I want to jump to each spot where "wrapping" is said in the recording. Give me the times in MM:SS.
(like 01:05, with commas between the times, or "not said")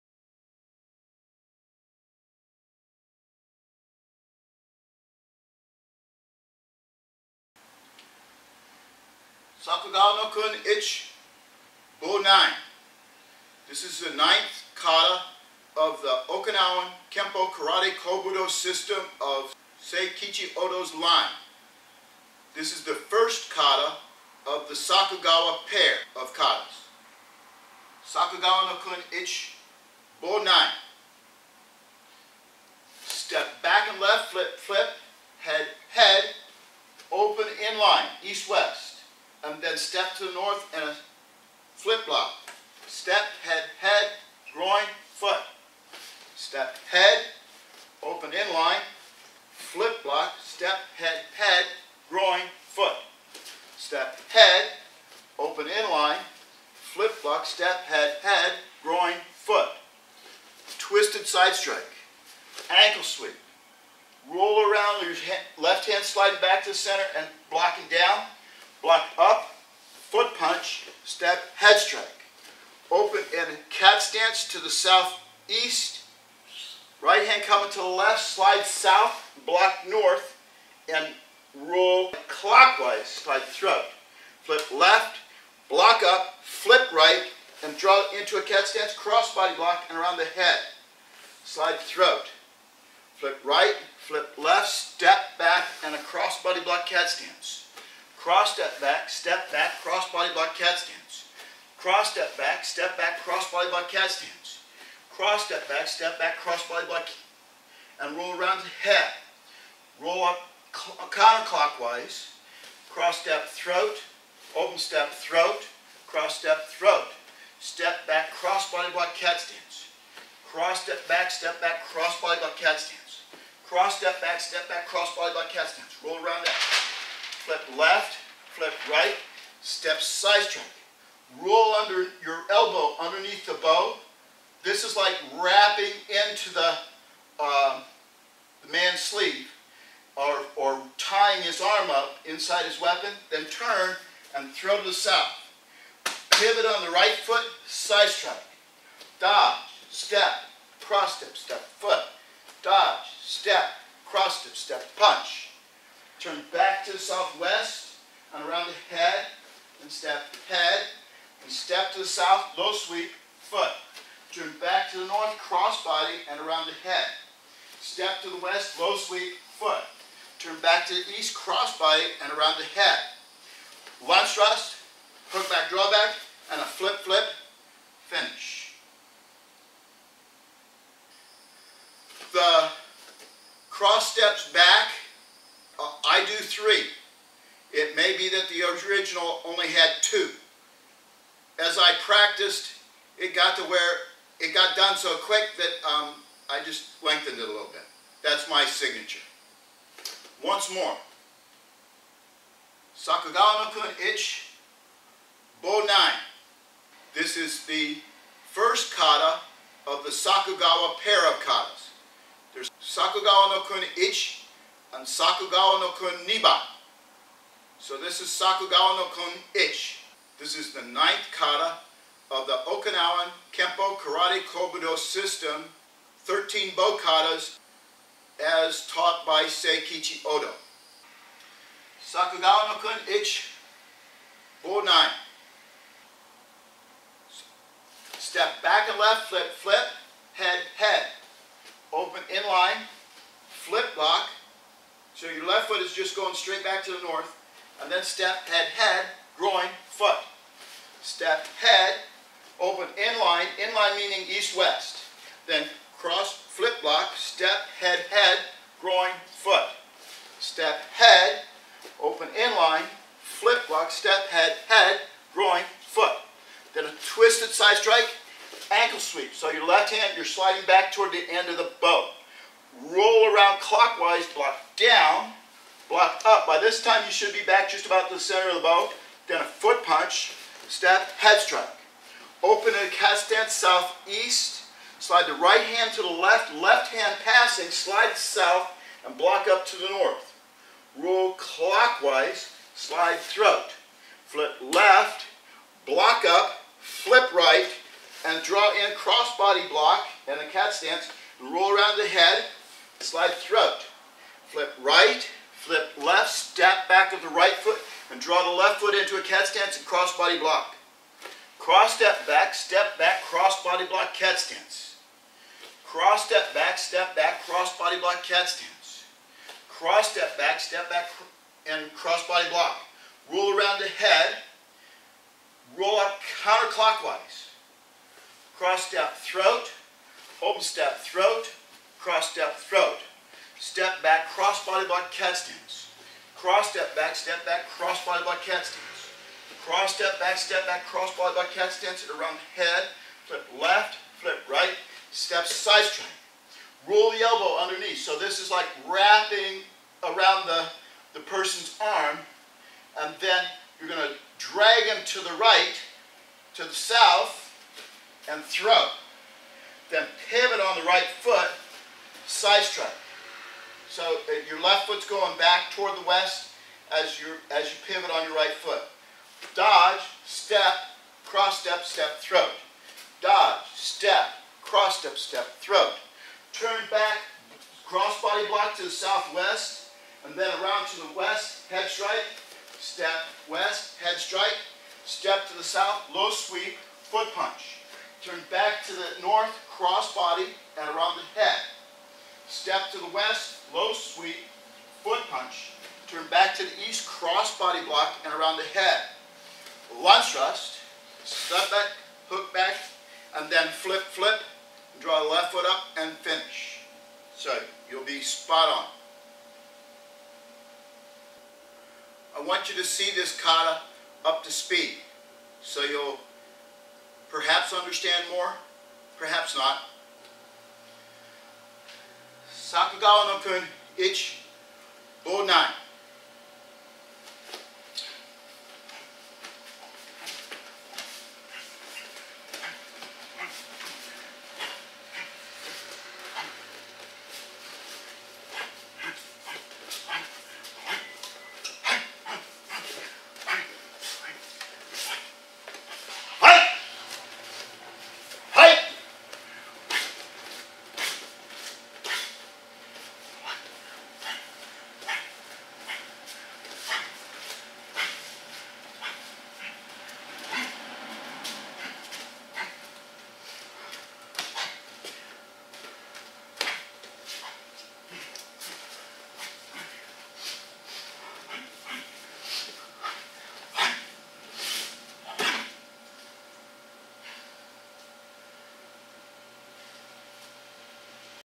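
02:15, 05:48.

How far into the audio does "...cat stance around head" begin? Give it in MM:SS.
05:41.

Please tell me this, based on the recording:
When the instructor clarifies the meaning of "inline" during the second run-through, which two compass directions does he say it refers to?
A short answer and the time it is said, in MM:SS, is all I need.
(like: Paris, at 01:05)
east-west, at 04:14.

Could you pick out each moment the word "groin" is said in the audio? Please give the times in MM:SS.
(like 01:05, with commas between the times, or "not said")
00:44, 00:52, 00:58, 04:09, 04:18, 04:25.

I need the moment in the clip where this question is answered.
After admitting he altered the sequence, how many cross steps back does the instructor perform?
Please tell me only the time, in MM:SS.
03:06.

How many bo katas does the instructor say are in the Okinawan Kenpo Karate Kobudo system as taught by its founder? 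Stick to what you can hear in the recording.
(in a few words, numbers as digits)
13.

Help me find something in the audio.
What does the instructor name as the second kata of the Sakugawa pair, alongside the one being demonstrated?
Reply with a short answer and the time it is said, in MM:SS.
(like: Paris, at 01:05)
Sakugawa no kun niba, at 03:35.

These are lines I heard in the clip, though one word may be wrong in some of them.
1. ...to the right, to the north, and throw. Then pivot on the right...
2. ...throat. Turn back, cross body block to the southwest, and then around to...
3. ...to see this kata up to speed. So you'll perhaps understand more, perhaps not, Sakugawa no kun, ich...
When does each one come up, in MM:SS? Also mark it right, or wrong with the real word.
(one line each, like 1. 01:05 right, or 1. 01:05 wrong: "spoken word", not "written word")
1. 05:55 wrong: "south", not "north"
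2. 06:15 right
3. 06:52 right.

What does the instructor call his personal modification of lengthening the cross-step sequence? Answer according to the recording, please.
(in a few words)
my signature.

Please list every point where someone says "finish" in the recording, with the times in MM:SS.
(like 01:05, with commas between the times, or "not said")
02:58, 06:46.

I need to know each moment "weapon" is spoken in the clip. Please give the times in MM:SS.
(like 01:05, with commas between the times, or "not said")
02:22.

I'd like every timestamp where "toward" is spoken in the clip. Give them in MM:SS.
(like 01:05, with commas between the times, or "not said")
04:30, 06:05.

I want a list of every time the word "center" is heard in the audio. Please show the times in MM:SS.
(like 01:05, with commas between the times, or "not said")
01:06, 04:38.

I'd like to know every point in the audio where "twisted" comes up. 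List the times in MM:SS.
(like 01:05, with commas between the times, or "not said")
01:00, 04:27.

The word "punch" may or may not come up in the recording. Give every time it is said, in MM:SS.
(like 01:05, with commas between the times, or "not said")
01:10, 02:34, 04:39, 06:27, 06:35.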